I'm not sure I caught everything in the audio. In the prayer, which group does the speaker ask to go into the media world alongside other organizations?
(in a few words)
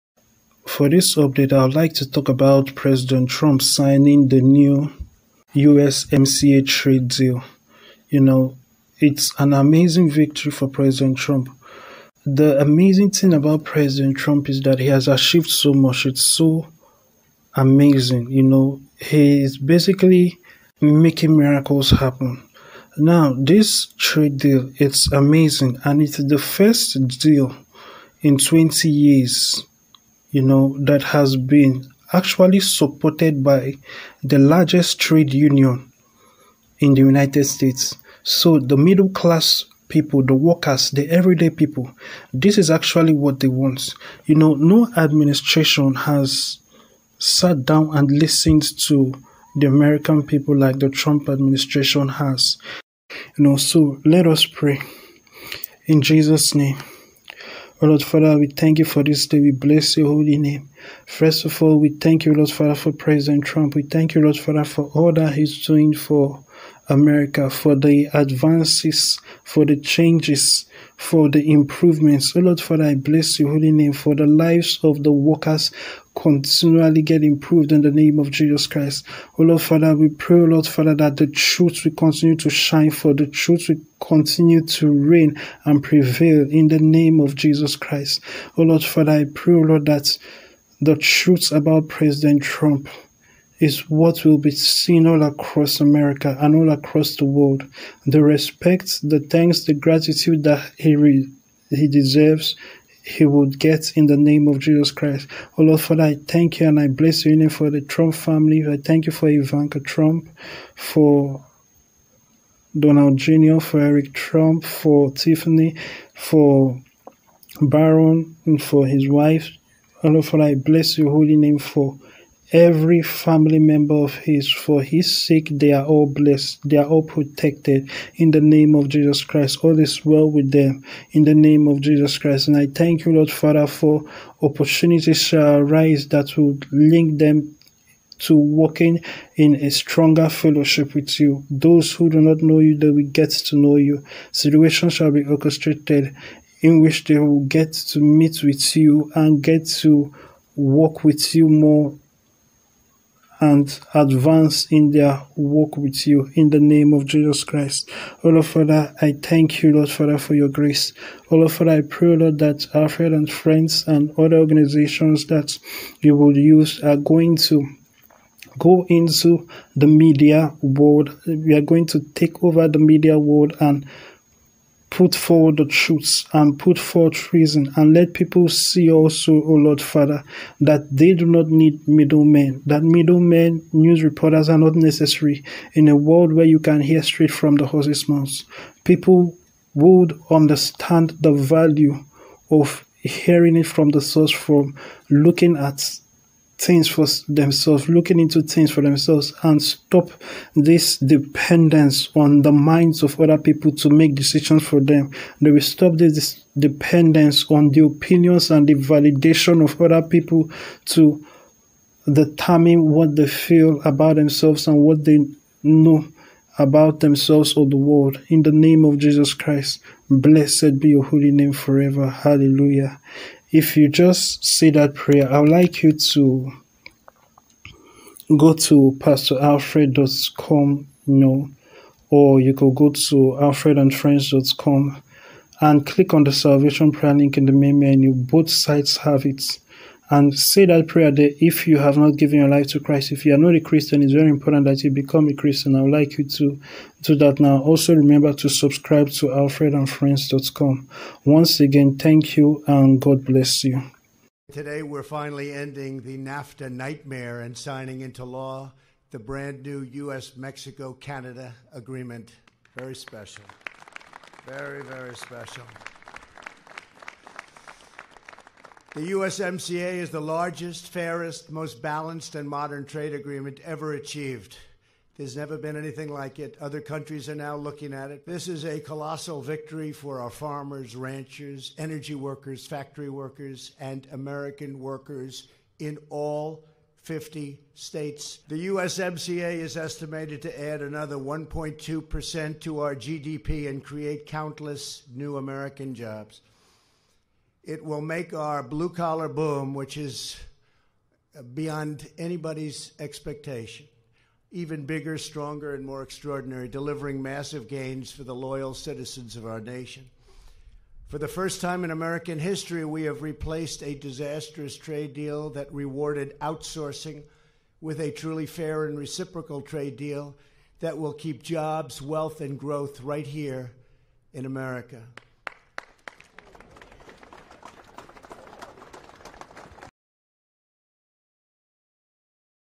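Alfred and friends.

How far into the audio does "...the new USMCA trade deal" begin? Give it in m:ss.
0:04.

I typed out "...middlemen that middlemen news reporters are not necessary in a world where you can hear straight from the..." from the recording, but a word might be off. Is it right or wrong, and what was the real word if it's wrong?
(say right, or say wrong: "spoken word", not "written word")
right.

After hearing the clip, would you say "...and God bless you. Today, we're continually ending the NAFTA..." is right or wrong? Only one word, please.
wrong.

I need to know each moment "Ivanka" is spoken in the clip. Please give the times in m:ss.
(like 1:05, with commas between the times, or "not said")
1:49.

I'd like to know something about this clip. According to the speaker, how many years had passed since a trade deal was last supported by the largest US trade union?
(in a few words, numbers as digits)
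20 years.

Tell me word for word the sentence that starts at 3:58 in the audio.
Both sites have it and say that prayer there if you have not given your life to Christ.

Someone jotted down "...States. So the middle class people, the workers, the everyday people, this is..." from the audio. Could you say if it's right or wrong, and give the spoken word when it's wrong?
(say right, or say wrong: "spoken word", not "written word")
right.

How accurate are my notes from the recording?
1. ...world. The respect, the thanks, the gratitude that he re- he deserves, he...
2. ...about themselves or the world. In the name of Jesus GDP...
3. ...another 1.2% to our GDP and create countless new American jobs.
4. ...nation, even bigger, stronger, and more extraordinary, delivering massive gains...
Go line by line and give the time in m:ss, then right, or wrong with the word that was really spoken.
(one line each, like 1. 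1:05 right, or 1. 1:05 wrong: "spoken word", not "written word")
1. 1:37 right
2. 3:36 wrong: "Christ", not "GDP"
3. 4:50 right
4. 5:02 wrong: "expectation", not "nation".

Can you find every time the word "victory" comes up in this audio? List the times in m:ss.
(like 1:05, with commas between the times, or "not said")
0:10, 4:39.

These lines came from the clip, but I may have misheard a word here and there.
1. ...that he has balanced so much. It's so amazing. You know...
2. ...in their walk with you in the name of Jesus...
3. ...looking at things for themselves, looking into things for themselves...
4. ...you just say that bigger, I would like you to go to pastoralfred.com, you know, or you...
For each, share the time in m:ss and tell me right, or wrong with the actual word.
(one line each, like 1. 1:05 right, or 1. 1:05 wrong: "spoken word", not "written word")
1. 0:14 wrong: "achieved", not "balanced"
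2. 2:34 right
3. 3:15 right
4. 3:43 wrong: "prayer", not "bigger".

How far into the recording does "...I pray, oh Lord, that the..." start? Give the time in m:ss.
1:29.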